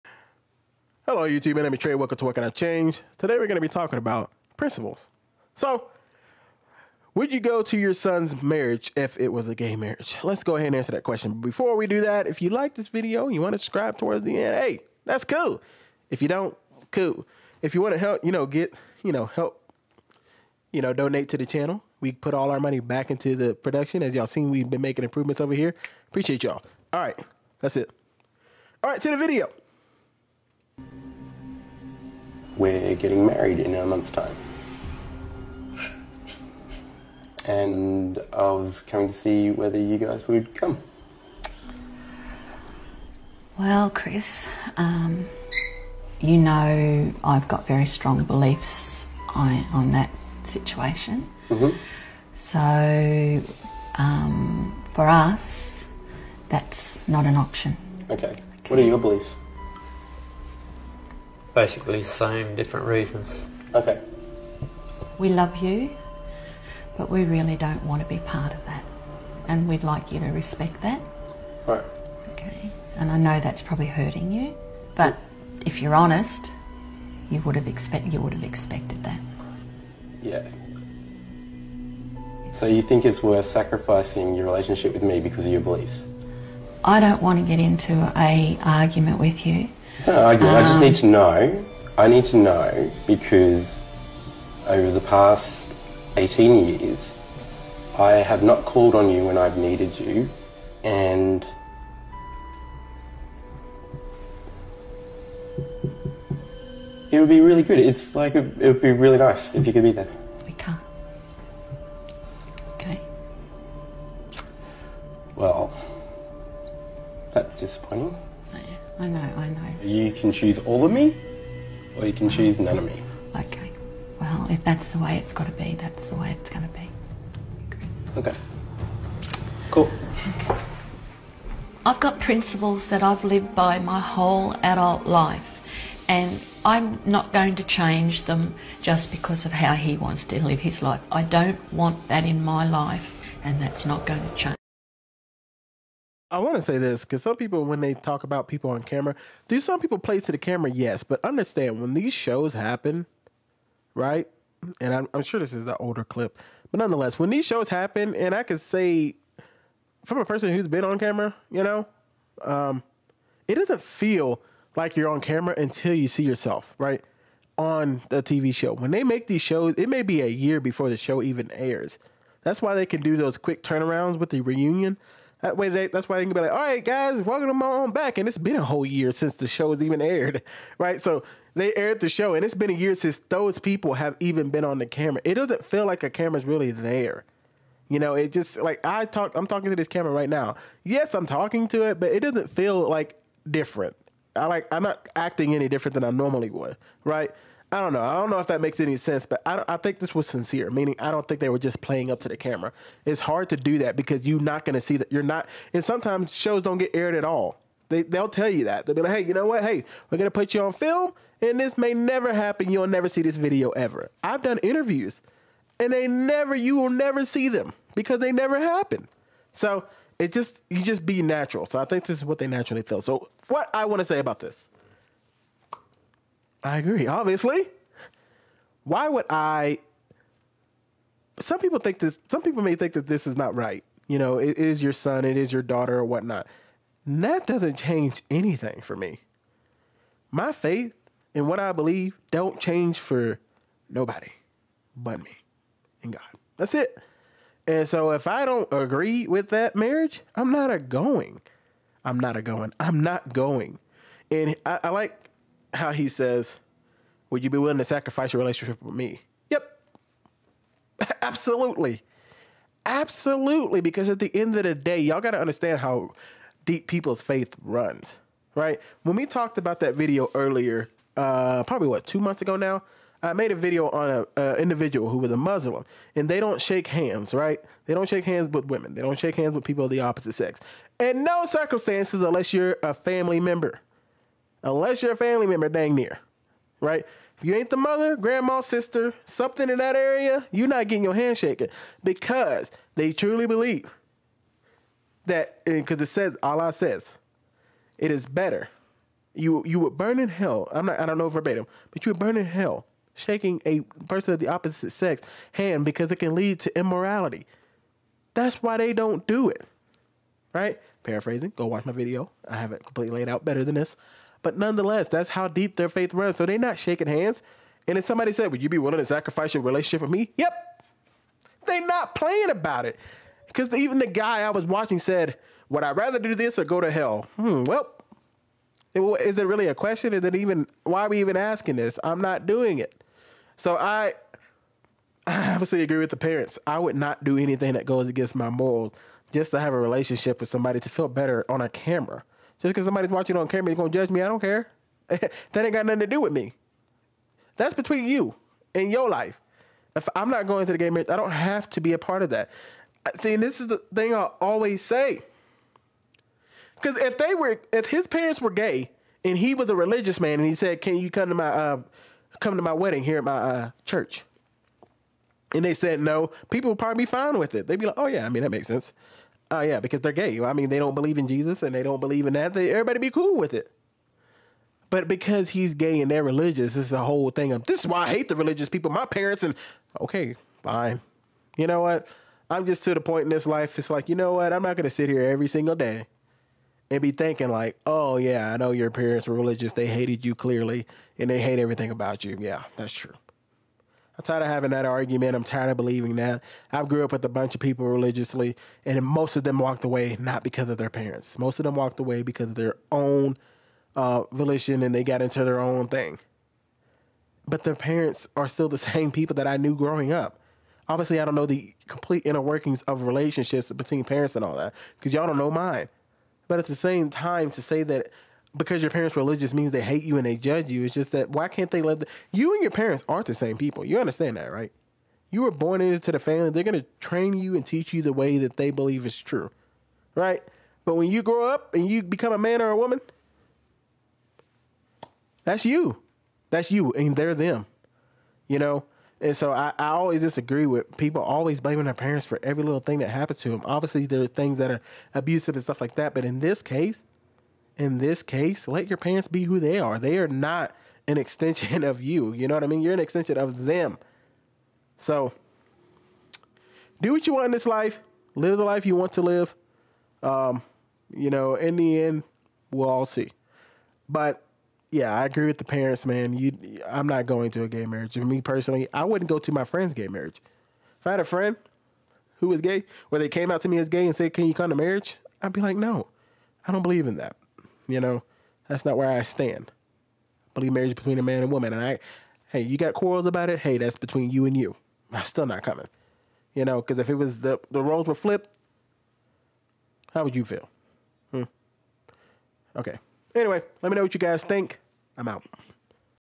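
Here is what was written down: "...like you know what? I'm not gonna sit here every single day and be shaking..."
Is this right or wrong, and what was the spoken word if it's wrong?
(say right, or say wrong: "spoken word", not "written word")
wrong: "thinking", not "shaking".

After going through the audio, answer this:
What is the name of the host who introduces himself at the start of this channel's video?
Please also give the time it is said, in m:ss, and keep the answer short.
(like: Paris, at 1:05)
Trey, at 0:01.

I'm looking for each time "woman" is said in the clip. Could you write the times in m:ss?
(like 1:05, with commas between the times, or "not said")
7:12, 8:01.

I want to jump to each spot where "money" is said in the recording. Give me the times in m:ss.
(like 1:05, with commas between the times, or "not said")
0:22.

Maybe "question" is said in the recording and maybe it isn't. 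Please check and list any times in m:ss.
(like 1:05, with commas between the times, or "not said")
0:11, 5:29.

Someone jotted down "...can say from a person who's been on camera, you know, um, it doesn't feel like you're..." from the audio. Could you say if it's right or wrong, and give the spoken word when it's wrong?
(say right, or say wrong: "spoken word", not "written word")
right.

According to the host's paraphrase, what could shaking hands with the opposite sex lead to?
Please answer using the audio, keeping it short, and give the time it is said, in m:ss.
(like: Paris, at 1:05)
Immorality, at 5:06.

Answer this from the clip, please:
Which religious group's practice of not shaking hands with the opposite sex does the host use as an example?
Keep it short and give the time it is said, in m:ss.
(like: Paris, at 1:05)
Muslim, at 4:35.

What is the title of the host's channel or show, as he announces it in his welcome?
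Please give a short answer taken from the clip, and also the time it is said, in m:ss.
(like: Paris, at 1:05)
What Can I Change?, at 0:02.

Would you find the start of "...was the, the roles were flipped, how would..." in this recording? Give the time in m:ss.
8:07.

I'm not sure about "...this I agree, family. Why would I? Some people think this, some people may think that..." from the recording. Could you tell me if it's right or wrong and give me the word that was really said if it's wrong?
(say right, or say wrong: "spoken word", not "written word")
wrong: "obviously", not "family".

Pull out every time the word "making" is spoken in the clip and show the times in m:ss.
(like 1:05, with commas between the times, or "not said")
0:24.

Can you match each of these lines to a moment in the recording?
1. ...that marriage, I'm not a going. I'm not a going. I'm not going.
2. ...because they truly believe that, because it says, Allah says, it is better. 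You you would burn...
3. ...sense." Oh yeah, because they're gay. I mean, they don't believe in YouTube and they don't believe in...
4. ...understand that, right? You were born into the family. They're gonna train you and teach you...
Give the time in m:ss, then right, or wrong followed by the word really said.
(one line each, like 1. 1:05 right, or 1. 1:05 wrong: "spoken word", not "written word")
1. 4:09 right
2. 4:52 right
3. 6:08 wrong: "Jesus", not "YouTube"
4. 7:03 right.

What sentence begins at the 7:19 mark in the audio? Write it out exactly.
And so I, I always disagree with people always blaming their parents for every little thing that happens to them.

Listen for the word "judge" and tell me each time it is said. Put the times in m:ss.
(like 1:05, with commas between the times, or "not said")
5:43, 7:00.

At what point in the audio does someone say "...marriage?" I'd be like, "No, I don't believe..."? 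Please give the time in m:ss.
7:54.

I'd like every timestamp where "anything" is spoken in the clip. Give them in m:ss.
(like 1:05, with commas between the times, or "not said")
3:58, 5:37.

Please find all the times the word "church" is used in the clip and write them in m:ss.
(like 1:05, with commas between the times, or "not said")
6:03.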